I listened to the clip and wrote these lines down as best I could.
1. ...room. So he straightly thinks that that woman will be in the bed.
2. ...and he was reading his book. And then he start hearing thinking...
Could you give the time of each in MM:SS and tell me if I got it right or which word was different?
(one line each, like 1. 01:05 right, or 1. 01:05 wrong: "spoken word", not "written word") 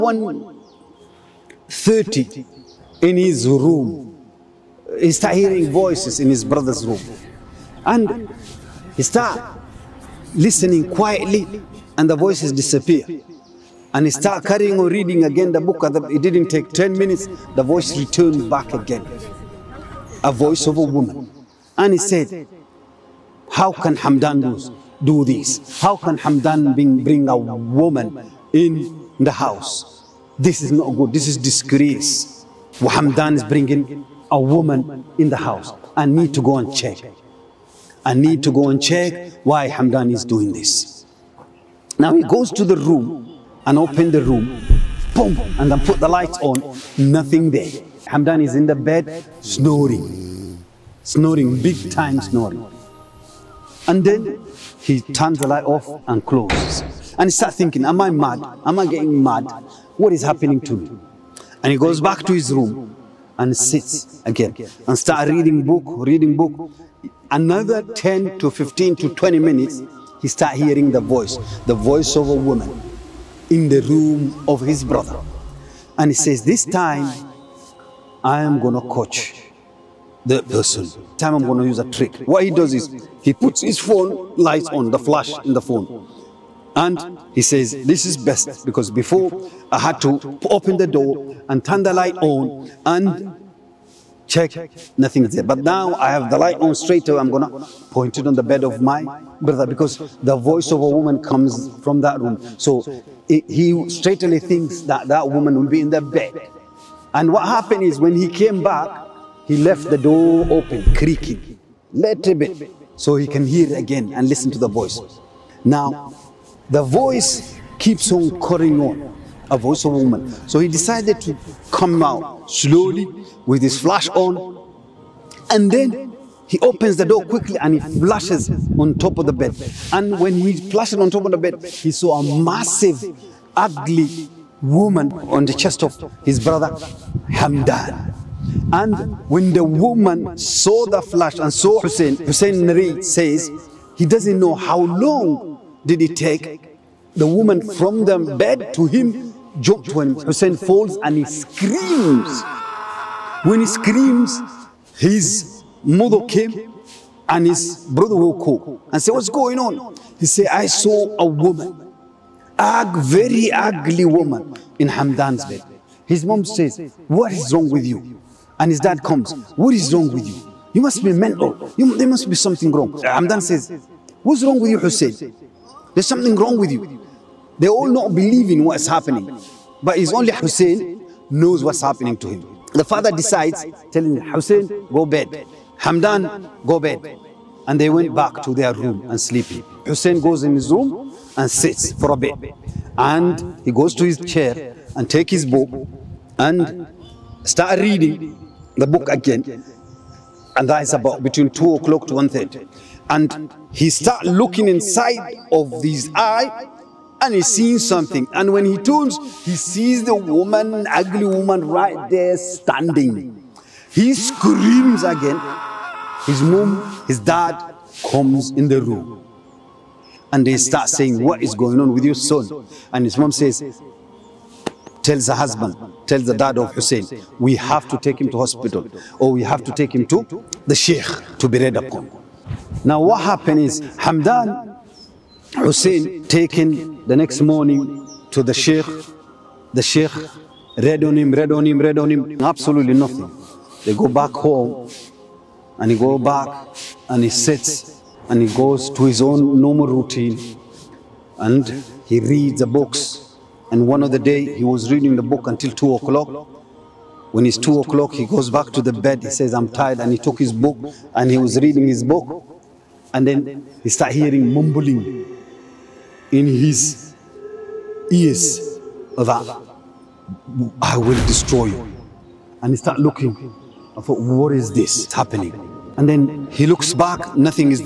1. 01:42 right
2. 04:21 wrong: "mumbling", not "thinking".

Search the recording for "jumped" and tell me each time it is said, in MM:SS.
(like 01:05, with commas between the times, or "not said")
02:29.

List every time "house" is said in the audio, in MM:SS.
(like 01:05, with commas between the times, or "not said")
00:29, 00:35.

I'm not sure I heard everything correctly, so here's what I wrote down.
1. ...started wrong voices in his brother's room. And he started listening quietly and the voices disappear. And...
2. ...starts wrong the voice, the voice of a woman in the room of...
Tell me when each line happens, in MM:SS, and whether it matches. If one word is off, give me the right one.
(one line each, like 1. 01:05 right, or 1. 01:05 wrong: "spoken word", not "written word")
1. 00:05 wrong: "hearing", not "wrong"
2. 01:10 wrong: "hearing", not "wrong".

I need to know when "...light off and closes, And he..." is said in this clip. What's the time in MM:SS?
00:55.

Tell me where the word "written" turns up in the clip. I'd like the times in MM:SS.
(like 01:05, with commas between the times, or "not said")
not said.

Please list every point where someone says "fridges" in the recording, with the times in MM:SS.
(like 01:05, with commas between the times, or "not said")
not said.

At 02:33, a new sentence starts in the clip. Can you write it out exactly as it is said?
When he screams, his mother came and his brother woke up and said, what's going on?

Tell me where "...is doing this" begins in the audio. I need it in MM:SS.
00:40.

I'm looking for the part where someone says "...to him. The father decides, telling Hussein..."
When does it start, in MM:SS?
03:02.